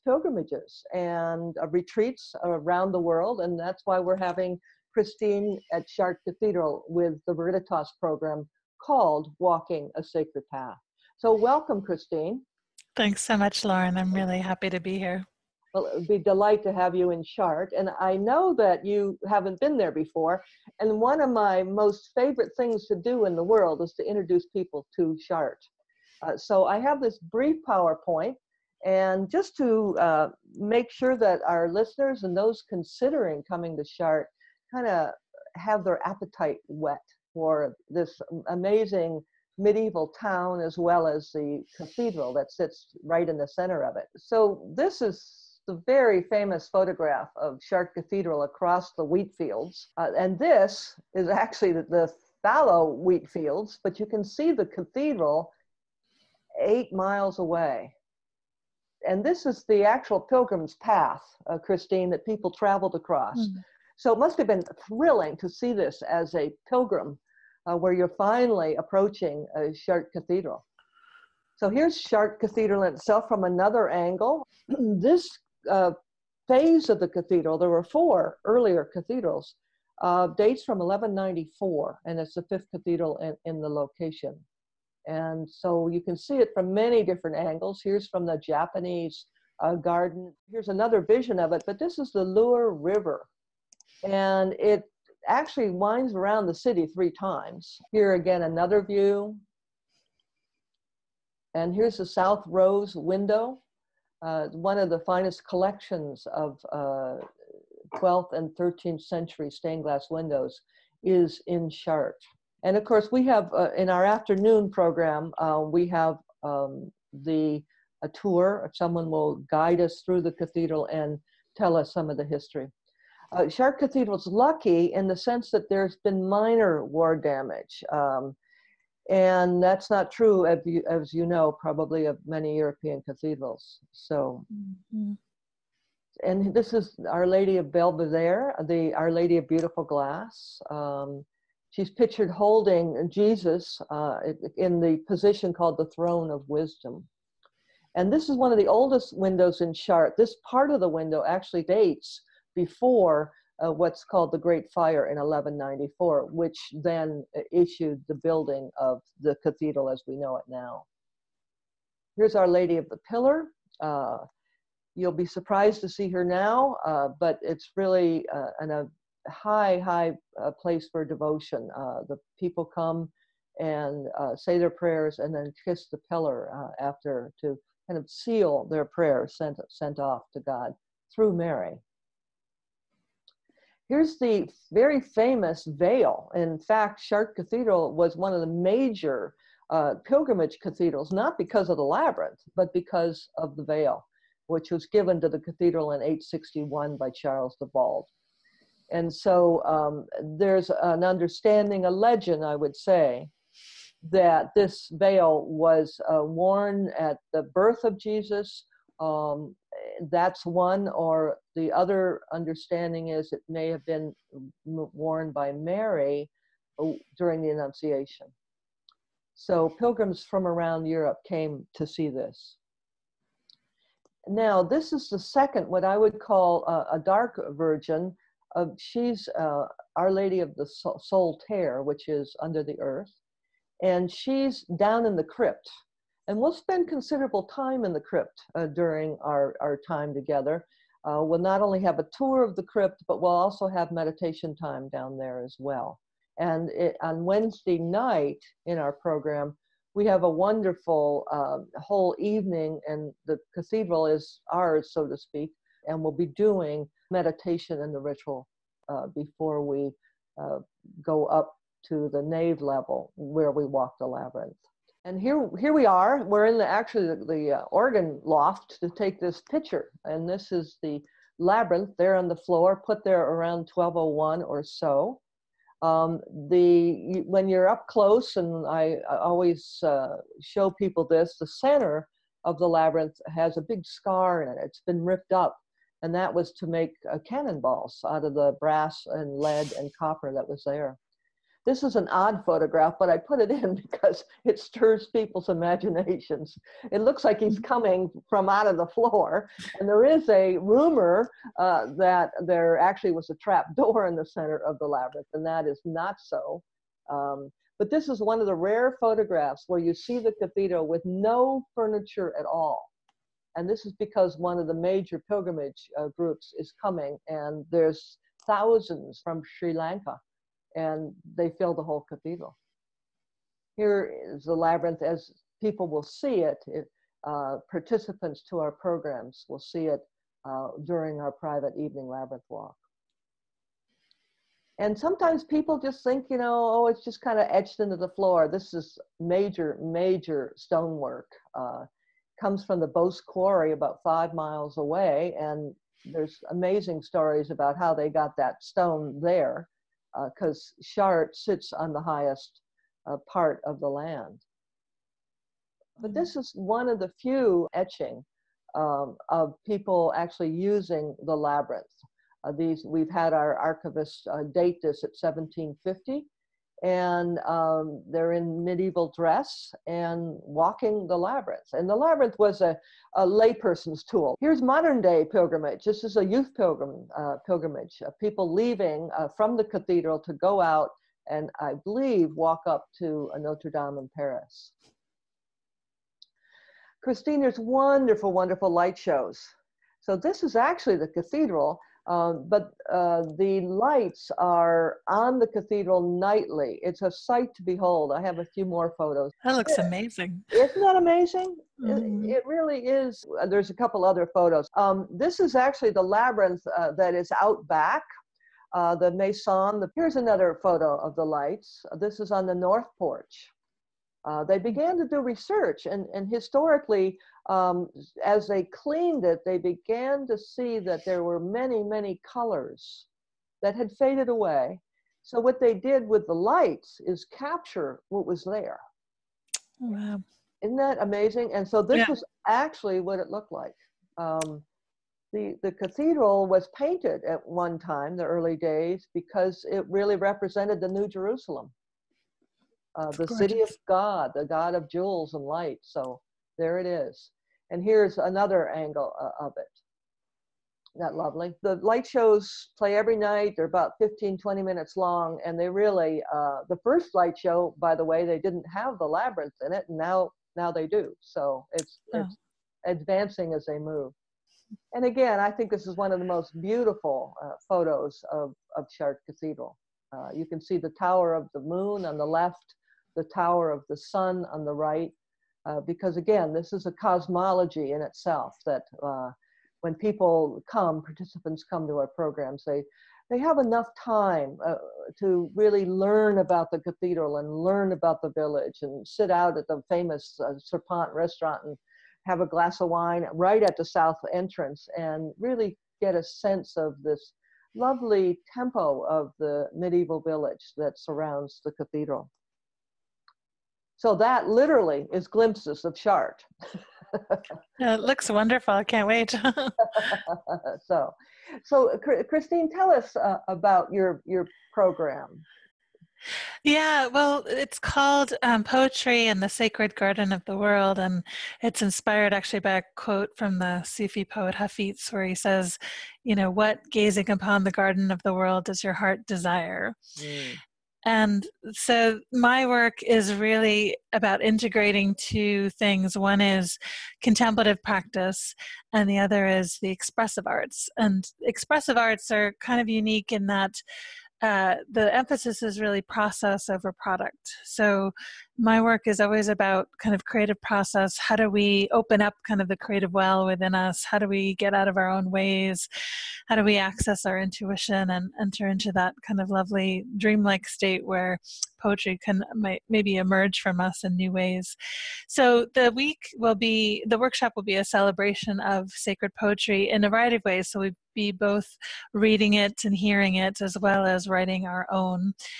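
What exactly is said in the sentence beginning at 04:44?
It's been ripped up, and that was to make uh, cannonballs out of the brass and lead and copper that was there.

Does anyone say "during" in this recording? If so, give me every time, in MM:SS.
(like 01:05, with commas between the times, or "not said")
03:37, 03:58, 05:30.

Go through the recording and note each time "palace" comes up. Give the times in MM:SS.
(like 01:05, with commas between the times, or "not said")
not said.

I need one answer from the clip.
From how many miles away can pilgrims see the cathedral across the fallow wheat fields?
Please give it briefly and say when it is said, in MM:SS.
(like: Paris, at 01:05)
8 miles, at 00:56.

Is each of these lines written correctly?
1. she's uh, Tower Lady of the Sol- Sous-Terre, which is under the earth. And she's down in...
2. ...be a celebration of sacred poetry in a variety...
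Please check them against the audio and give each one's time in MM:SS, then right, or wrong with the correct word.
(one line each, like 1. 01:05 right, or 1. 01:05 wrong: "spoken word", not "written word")
1. 03:48 wrong: "Our", not "Tower"
2. 09:27 right.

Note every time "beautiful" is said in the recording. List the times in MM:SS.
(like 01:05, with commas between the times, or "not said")
02:19, 07:46.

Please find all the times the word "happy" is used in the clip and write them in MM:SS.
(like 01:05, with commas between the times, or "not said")
00:14.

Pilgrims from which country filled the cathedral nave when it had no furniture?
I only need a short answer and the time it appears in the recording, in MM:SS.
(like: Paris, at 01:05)
Sri Lanka, at 05:19.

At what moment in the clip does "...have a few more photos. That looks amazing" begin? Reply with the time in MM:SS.
06:38.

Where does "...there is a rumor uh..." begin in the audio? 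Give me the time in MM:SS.
04:59.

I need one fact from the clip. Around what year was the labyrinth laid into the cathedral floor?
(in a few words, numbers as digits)
1201.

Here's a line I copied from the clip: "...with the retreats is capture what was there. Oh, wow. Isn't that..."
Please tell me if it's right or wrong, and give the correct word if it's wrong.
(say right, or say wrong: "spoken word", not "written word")
wrong: "lights", not "retreats".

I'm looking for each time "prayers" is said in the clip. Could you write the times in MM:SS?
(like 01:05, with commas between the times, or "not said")
02:54, 02:58.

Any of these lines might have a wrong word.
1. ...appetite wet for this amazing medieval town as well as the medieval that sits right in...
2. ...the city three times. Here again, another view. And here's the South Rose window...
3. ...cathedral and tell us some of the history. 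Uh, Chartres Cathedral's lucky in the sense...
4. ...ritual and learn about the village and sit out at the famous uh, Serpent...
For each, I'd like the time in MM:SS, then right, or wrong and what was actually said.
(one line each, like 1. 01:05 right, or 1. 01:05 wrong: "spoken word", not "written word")
1. 00:36 wrong: "cathedral", not "medieval"
2. 01:36 right
3. 02:00 right
4. 08:06 wrong: "cathedral", not "ritual".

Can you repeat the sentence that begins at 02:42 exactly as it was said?
Here's Our Lady of the Pillar.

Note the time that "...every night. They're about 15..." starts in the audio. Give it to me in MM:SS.
07:32.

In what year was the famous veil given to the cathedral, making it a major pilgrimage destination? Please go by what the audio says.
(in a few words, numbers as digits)
861.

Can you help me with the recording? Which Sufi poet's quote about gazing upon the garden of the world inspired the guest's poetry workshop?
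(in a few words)
Hafiz.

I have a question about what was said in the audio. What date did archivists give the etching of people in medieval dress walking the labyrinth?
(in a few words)
1750.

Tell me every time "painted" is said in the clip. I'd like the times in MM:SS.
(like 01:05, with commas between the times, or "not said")
07:16.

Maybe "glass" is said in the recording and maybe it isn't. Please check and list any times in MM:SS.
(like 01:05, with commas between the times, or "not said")
01:49, 02:19, 08:12.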